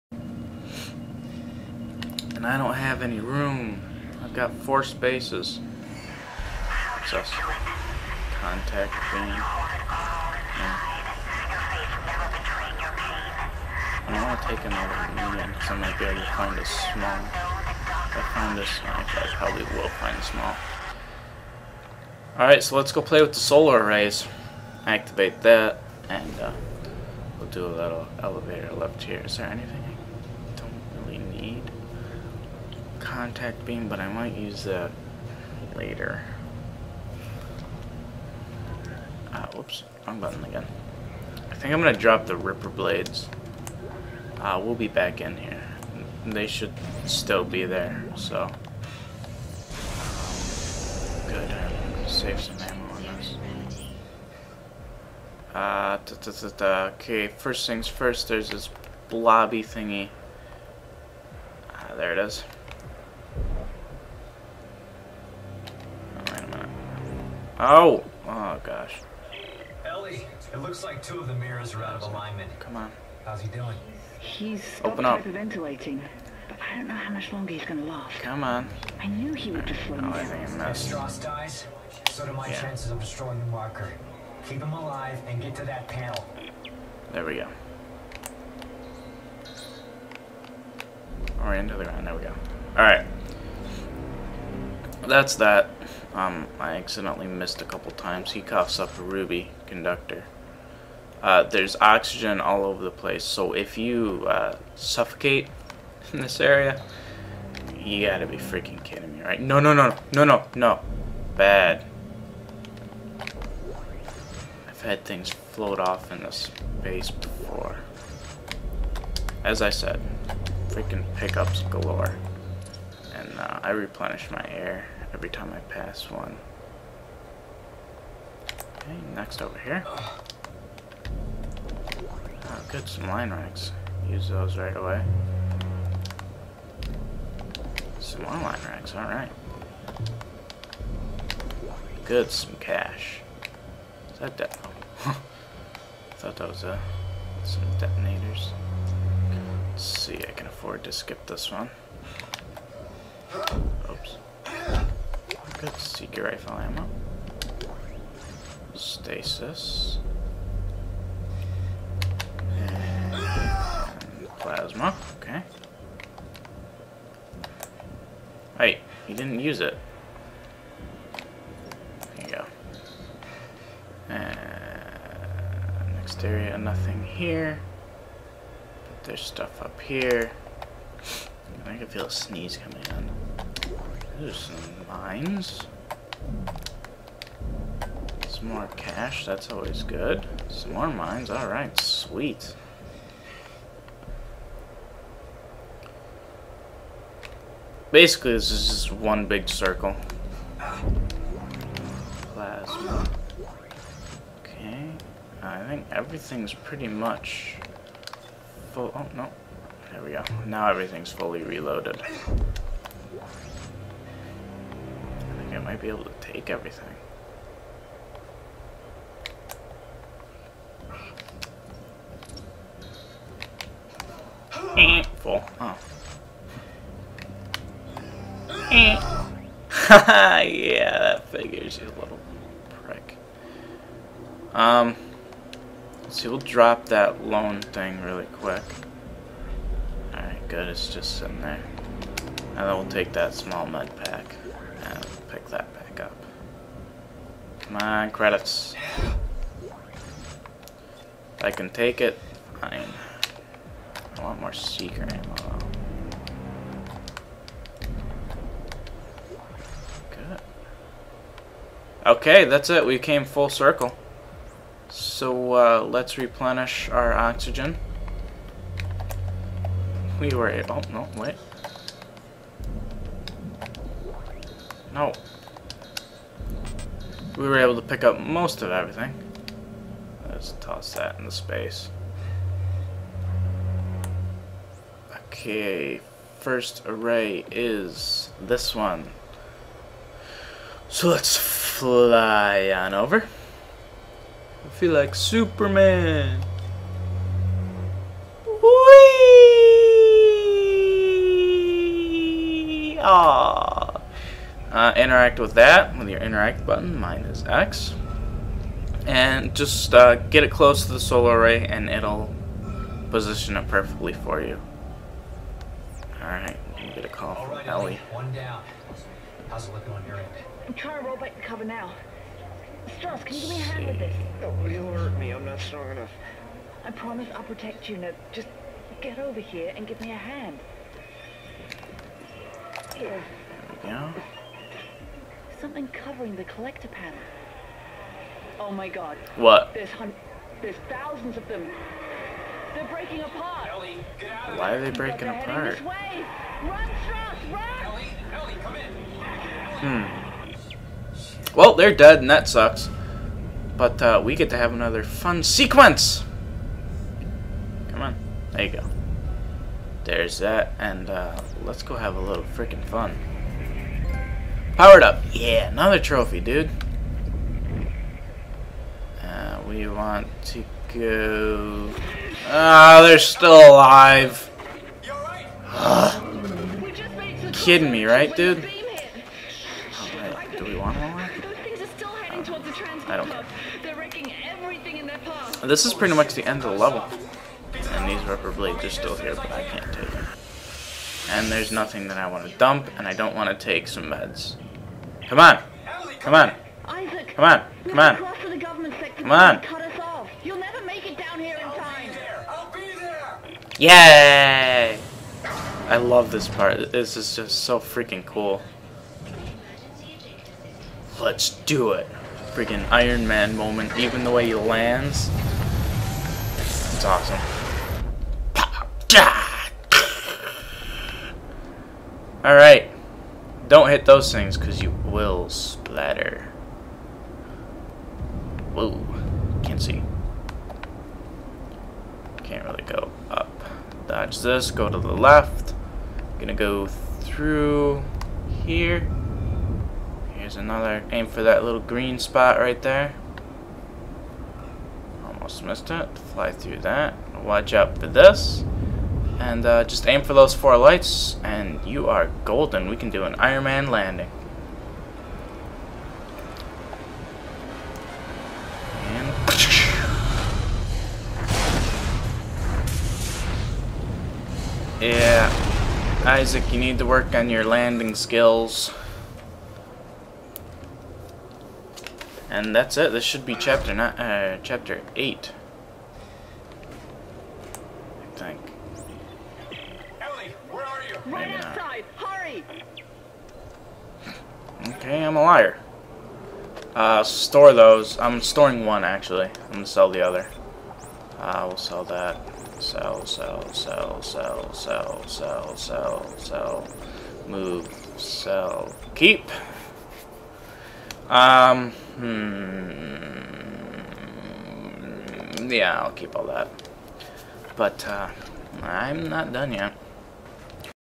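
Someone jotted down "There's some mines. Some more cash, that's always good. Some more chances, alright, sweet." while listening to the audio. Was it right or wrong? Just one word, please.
wrong.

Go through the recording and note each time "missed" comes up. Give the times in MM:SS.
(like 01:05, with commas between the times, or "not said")
01:37, 07:25.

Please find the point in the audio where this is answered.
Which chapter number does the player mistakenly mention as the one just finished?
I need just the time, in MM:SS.
07:54.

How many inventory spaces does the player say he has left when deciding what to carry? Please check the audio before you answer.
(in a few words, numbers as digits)
4.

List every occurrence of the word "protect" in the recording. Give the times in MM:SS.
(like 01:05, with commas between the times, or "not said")
05:27.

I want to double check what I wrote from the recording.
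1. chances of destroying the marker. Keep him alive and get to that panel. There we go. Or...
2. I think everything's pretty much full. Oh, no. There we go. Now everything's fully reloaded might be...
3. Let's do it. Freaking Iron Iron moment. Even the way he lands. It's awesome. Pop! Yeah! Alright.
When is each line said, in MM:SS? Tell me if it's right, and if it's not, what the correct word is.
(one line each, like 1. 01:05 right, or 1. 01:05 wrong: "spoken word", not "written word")
1. 01:22 right
2. 03:25 right
3. 06:51 wrong: "Man", not "Iron".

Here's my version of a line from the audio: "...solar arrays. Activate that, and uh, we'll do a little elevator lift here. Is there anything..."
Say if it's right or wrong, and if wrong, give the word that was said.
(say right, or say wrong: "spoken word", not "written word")
right.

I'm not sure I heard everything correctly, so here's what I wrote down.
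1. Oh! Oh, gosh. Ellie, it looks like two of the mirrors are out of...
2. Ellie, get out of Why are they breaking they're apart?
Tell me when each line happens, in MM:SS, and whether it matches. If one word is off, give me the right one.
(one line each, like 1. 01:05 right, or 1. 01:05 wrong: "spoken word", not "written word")
1. 01:07 right
2. 05:43 right.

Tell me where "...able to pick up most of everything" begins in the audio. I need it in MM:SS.
04:37.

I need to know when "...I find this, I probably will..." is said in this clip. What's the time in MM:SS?
00:18.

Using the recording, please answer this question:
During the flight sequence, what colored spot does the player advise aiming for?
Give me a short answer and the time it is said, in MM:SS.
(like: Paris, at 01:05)
green, at 07:21.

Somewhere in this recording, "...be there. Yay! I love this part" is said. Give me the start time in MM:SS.
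06:42.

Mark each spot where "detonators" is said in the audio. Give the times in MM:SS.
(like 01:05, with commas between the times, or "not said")
02:27.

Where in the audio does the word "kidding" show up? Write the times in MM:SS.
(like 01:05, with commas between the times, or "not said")
01:48, 06:17.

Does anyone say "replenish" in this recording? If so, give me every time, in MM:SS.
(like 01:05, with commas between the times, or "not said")
02:03, 04:26.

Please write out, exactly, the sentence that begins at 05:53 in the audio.
But uh, we get to have another fun sequence.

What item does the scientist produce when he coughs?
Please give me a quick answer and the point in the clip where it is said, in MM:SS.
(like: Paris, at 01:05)
ruby conductor, at 01:39.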